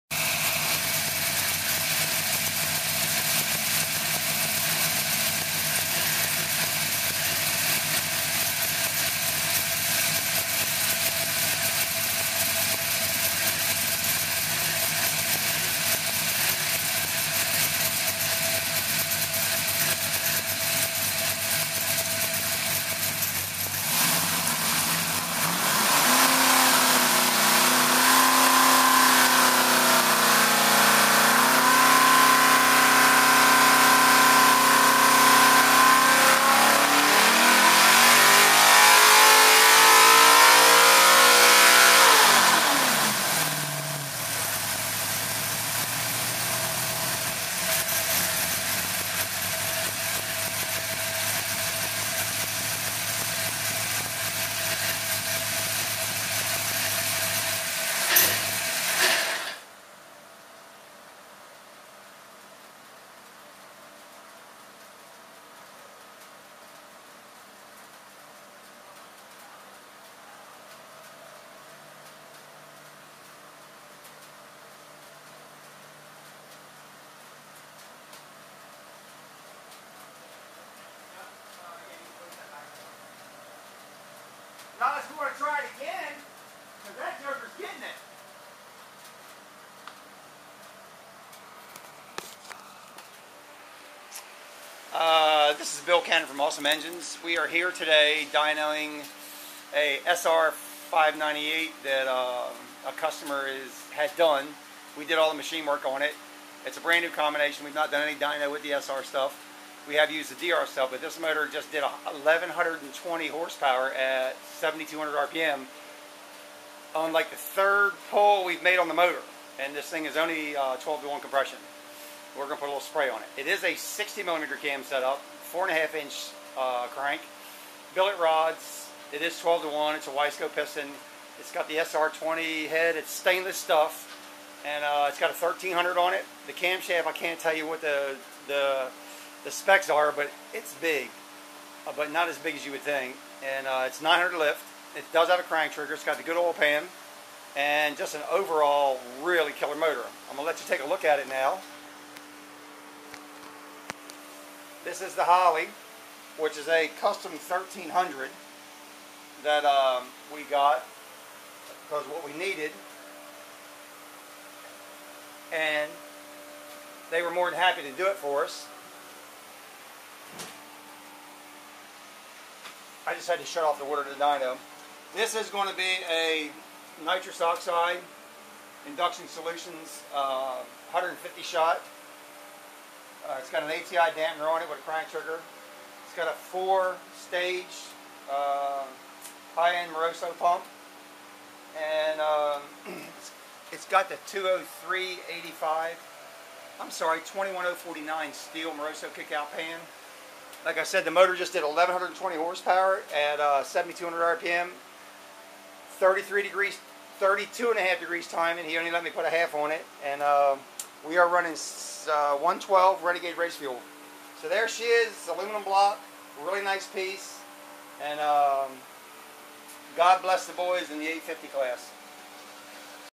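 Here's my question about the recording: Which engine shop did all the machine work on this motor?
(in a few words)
Awesome Engines.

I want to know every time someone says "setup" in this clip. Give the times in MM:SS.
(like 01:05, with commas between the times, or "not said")
02:04.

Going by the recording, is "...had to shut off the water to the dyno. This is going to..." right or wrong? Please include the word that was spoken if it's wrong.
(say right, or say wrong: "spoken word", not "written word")
right.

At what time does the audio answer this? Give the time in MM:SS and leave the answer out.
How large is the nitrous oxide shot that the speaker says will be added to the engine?
03:00.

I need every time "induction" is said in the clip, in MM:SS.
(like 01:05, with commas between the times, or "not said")
02:58.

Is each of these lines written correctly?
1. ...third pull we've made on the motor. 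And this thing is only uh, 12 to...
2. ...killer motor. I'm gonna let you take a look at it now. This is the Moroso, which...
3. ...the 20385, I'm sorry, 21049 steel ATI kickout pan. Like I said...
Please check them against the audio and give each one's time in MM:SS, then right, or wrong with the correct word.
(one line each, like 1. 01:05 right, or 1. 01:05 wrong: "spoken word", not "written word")
1. 01:57 right
2. 02:29 wrong: "Holley", not "Moroso"
3. 03:14 wrong: "Moroso", not "ATI".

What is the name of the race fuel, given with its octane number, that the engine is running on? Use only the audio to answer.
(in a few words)
112 Renegade.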